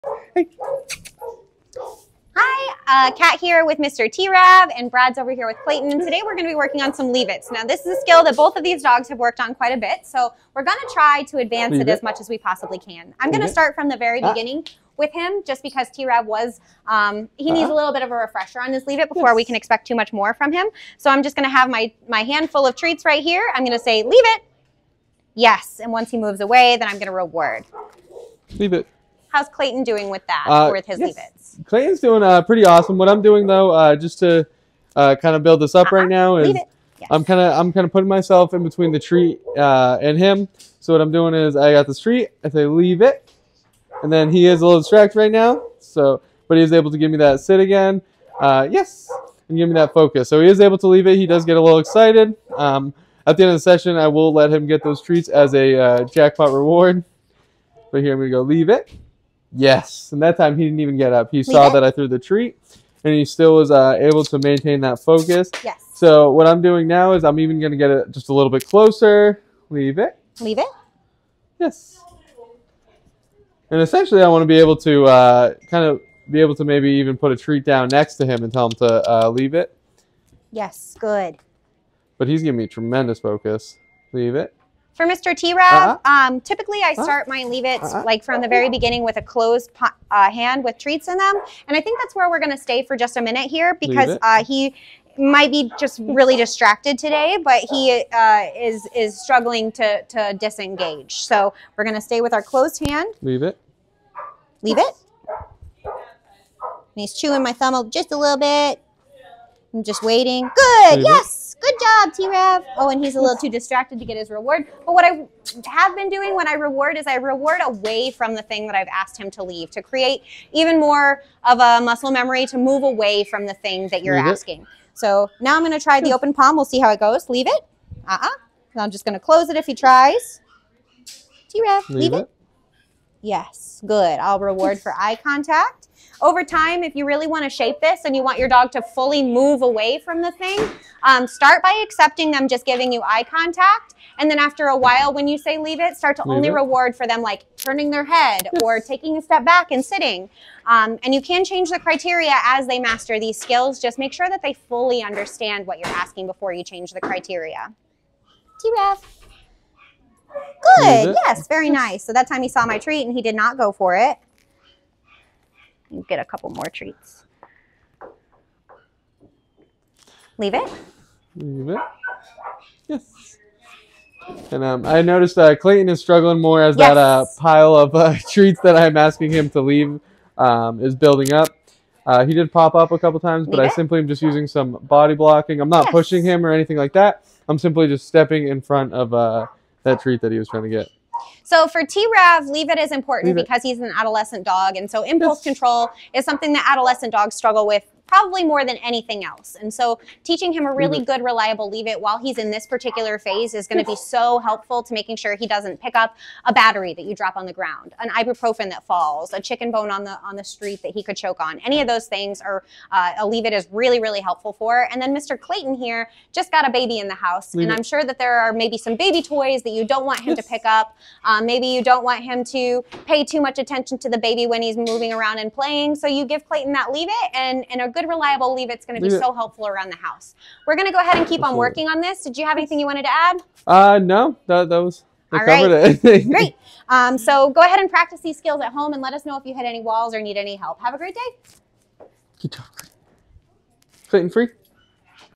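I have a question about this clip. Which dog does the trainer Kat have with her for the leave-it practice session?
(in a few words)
Mr. T-Rav.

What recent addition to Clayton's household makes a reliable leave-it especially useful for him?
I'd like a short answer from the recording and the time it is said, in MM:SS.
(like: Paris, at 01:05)
a baby, at 03:36.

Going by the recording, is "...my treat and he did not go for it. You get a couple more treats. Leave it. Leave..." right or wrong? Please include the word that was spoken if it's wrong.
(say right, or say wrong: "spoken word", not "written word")
right.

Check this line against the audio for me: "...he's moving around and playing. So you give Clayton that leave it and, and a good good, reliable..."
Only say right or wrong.
right.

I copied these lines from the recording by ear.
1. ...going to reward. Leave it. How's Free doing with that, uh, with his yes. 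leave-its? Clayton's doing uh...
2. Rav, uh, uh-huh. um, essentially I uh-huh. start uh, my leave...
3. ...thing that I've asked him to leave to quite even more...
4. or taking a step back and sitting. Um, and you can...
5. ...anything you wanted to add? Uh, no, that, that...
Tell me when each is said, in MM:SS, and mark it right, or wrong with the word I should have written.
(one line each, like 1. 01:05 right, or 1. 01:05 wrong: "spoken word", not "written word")
1. 00:26 wrong: "Clayton", not "Free"
2. 01:25 wrong: "typically", not "essentially"
3. 01:58 wrong: "create", not "quite"
4. 02:28 right
5. 03:52 right.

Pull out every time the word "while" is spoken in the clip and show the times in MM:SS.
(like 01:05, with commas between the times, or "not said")
02:24, 03:22.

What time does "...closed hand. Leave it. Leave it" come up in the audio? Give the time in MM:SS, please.
01:42.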